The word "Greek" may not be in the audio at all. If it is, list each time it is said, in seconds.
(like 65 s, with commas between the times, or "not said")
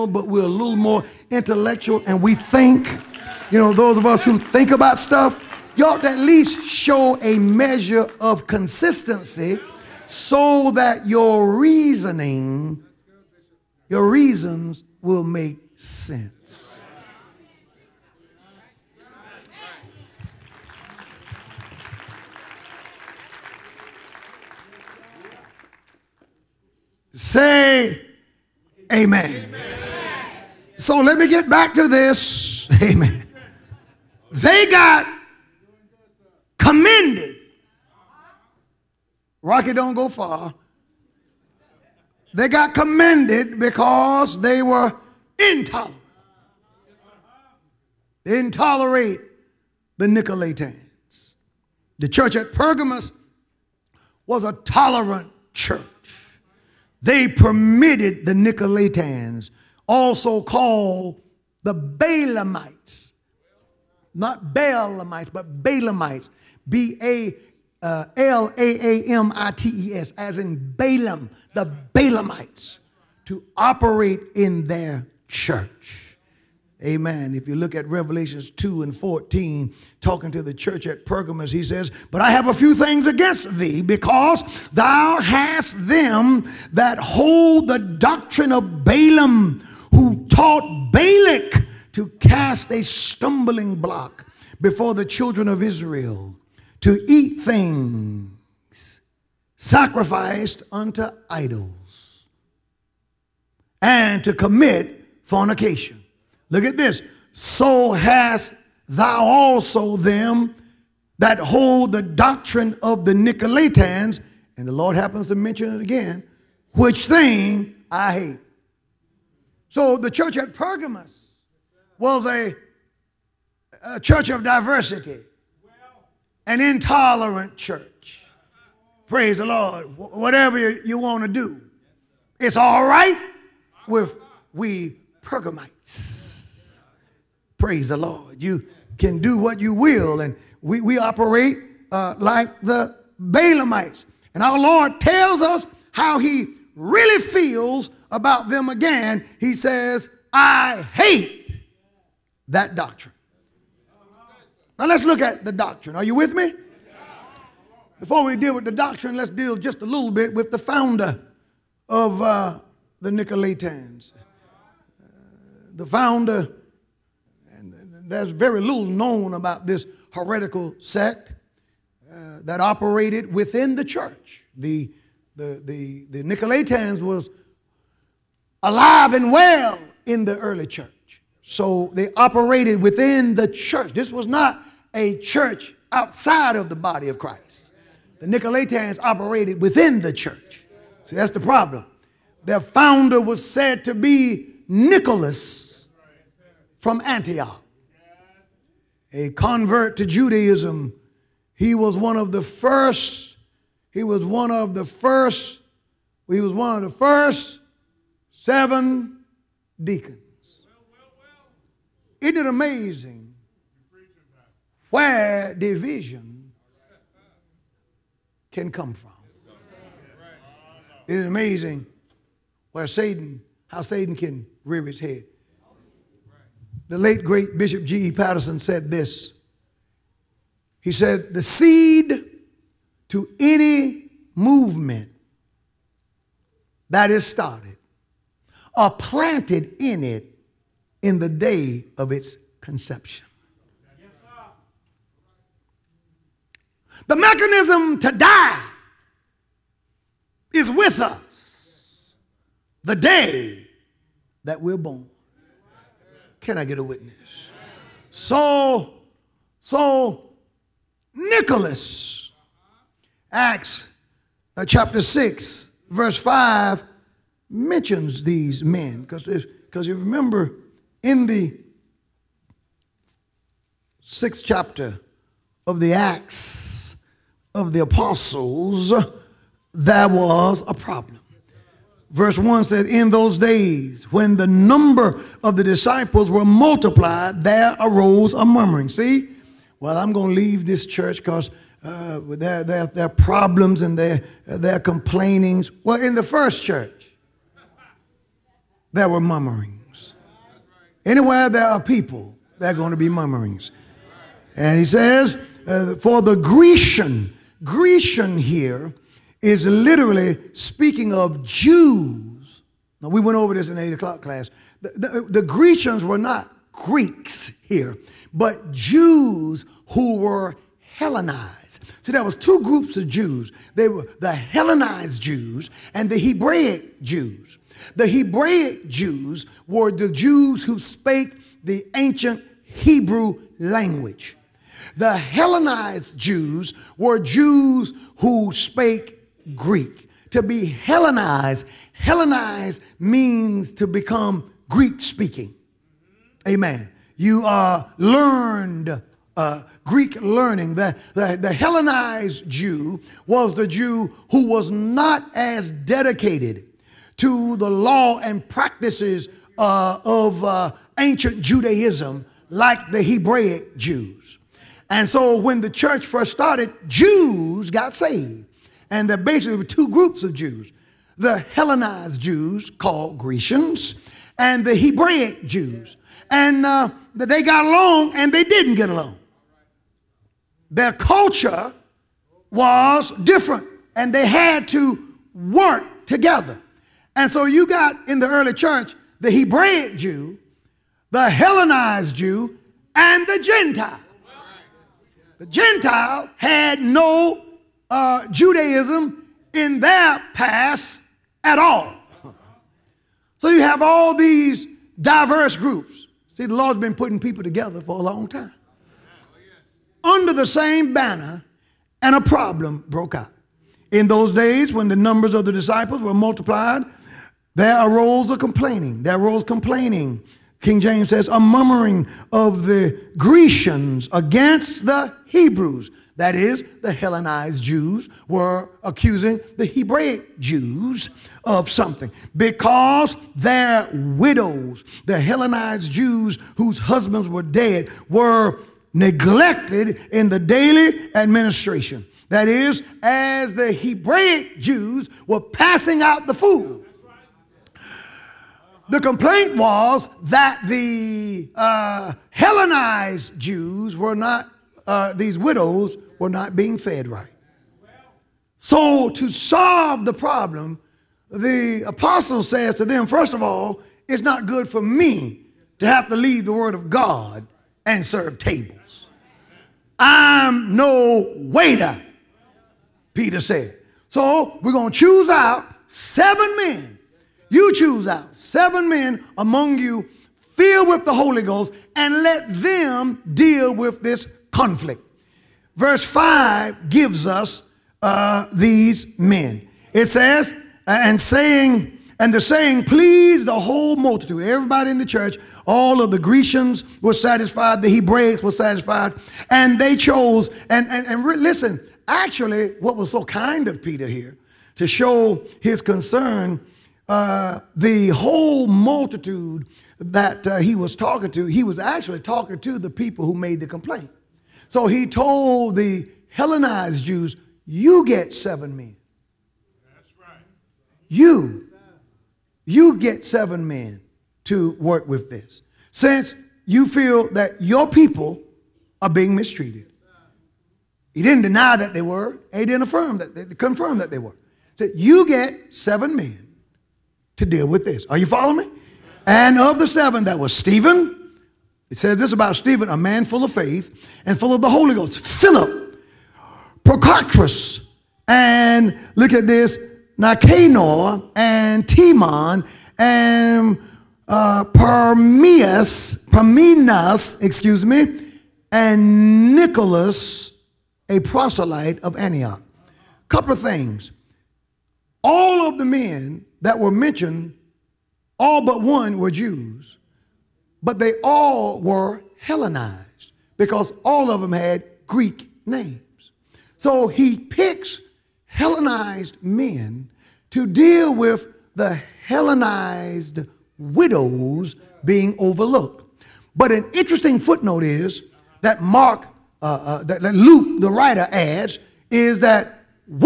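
316 s, 339 s, 344 s, 349 s, 575 s.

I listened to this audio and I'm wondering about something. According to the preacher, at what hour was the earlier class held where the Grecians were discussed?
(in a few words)
8 o'clock.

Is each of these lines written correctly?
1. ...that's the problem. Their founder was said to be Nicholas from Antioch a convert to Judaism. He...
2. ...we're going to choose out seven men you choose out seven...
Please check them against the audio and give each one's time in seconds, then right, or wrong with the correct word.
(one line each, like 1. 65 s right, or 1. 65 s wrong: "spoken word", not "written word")
1. 191 s right
2. 474 s right.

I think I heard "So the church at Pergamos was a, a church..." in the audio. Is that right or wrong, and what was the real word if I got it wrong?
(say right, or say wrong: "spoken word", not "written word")
right.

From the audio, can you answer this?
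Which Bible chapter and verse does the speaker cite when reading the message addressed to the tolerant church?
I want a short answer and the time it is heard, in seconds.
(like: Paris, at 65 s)
Revelation 2:14, at 77 s.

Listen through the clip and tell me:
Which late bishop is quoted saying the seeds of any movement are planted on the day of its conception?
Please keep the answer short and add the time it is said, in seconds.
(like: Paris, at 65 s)
G.E. Patterson, at 227 s.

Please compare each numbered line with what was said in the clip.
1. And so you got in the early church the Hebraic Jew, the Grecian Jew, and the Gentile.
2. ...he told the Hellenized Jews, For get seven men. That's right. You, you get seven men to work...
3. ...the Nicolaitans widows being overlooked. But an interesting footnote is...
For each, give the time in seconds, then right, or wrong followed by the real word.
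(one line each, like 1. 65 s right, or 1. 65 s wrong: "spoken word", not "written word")
1. 387 s wrong: "Hellenized", not "Grecian"
2. 514 s wrong: "You", not "For"
3. 581 s wrong: "Hellenized", not "Nicolaitans".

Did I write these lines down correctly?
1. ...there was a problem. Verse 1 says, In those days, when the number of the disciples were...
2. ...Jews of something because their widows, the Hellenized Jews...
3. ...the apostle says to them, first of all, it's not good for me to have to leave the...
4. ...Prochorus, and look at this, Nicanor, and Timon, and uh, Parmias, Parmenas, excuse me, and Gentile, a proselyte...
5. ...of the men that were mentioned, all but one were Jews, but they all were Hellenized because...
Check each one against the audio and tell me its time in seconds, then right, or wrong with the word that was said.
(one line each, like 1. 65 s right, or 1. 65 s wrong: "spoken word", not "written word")
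1. 279 s right
2. 430 s right
3. 461 s right
4. 546 s wrong: "Nicholas", not "Gentile"
5. 565 s right.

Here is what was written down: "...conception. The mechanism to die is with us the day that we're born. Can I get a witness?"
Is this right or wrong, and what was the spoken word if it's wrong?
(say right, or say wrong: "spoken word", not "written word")
right.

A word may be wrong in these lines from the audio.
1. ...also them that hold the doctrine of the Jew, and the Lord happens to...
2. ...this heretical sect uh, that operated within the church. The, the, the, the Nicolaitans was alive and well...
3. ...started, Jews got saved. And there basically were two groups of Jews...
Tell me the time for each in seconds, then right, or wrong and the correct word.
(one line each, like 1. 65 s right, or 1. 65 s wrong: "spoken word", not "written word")
1. 109 s wrong: "Nicolaitans", not "Jew"
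2. 169 s right
3. 366 s right.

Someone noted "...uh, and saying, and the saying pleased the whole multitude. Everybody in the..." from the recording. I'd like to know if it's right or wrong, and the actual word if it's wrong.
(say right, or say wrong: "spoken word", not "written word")
right.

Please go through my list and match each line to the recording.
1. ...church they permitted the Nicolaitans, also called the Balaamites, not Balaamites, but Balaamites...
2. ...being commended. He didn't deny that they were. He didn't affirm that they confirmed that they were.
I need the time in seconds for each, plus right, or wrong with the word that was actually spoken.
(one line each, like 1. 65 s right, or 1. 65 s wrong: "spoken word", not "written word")
1. 55 s right
2. 529 s wrong: "mistreated", not "commended".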